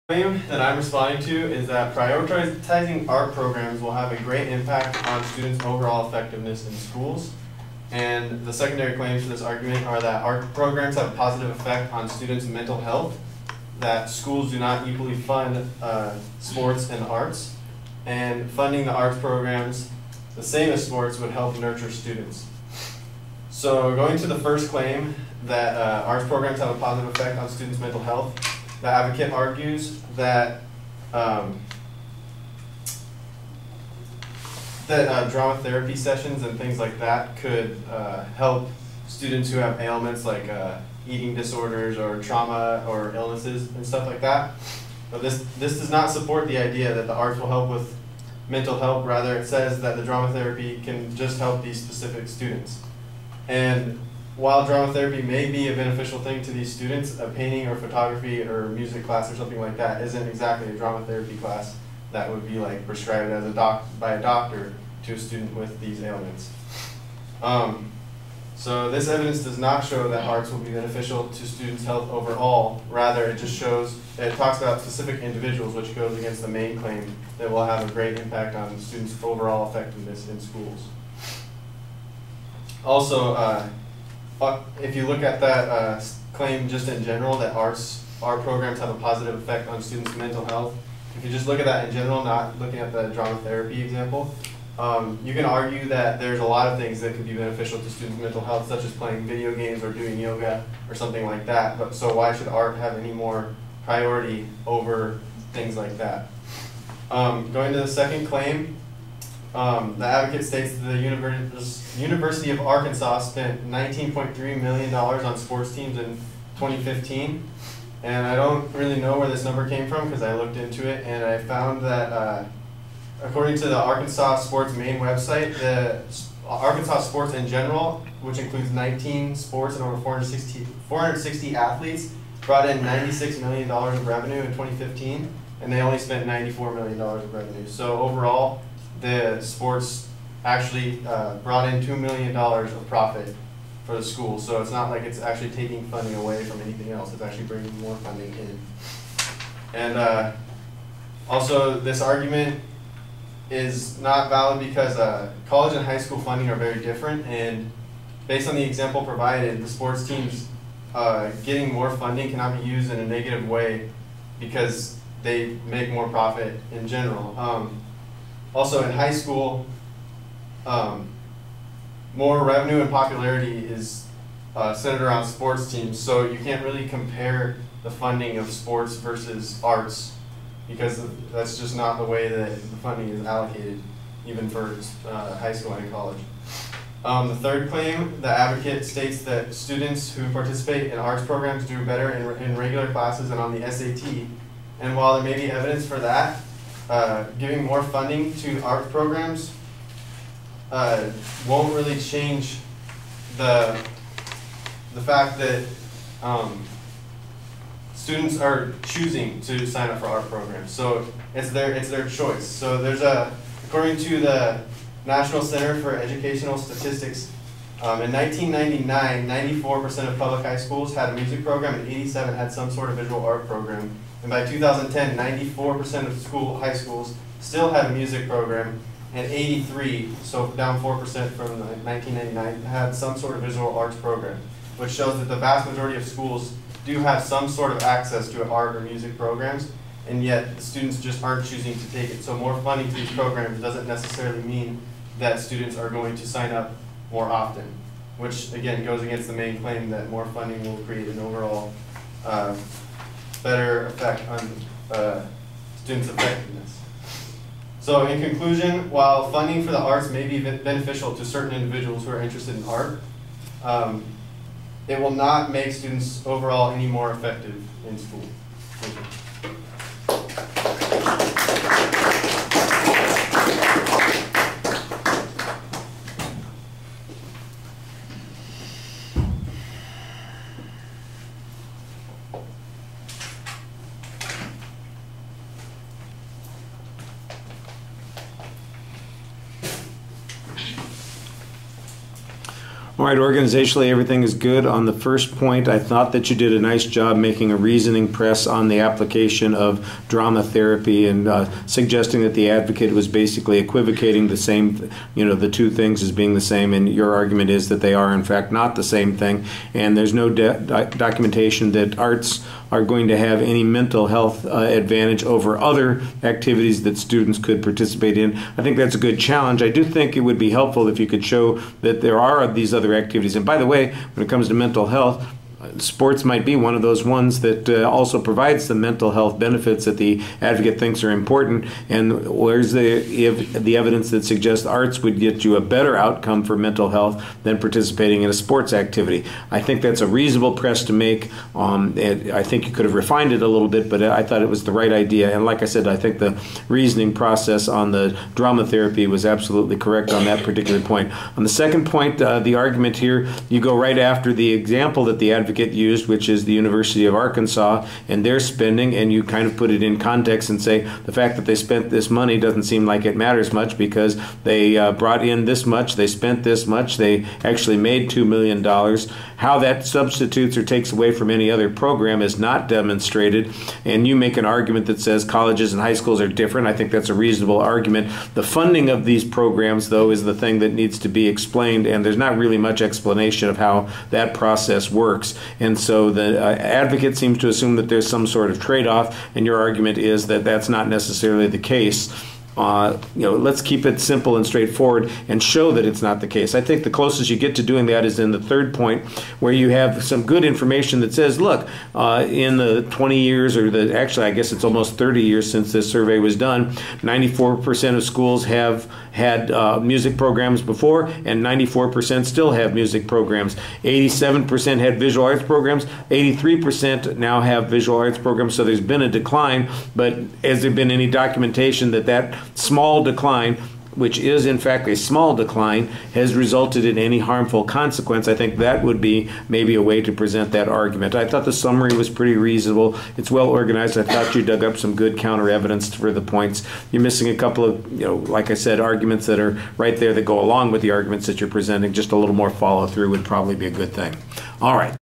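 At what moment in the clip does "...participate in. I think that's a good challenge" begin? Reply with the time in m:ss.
5:17.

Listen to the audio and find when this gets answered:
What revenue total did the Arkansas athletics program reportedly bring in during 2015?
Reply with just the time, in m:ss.
2:12.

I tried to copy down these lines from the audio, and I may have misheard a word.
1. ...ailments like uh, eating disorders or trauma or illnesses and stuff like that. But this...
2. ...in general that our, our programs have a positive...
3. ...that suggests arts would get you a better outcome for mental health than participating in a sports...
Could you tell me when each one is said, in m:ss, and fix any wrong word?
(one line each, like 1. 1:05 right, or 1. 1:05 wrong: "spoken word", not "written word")
1. 0:39 right
2. 1:26 right
3. 5:34 right.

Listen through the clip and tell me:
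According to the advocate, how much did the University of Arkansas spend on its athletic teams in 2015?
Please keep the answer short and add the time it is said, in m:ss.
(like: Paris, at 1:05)
$19.3 million, at 1:53.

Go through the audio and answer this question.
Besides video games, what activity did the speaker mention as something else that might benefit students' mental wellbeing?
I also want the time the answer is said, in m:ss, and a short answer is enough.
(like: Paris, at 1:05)
yoga, at 1:40.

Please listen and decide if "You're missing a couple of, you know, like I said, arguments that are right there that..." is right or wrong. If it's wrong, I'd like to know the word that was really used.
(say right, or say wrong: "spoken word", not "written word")
right.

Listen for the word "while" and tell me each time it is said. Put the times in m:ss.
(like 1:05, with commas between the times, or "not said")
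0:54, 3:14, 4:18.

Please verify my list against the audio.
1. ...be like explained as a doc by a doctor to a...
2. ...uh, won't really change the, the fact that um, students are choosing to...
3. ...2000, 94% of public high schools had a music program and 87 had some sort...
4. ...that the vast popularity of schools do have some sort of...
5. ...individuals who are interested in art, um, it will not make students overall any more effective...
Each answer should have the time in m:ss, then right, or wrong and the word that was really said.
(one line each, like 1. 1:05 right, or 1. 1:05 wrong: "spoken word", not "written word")
1. 1:02 wrong: "prescribed", not "explained"
2. 3:20 right
3. 3:38 wrong: "1999", not "2000"
4. 3:55 wrong: "majority", not "popularity"
5. 4:21 right.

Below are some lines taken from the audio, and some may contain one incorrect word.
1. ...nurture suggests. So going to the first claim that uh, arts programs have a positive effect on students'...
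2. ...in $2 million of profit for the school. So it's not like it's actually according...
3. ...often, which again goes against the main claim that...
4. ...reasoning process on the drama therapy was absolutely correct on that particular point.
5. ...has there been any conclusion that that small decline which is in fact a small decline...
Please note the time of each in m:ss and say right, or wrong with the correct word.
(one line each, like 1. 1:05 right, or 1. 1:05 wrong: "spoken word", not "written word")
1. 0:21 wrong: "students", not "suggests"
2. 2:21 wrong: "taking", not "according"
3. 4:07 right
4. 5:46 right
5. 7:00 wrong: "documentation", not "conclusion".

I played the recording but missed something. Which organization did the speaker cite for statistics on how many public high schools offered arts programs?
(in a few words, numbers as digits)
National Center for Educational Statistics.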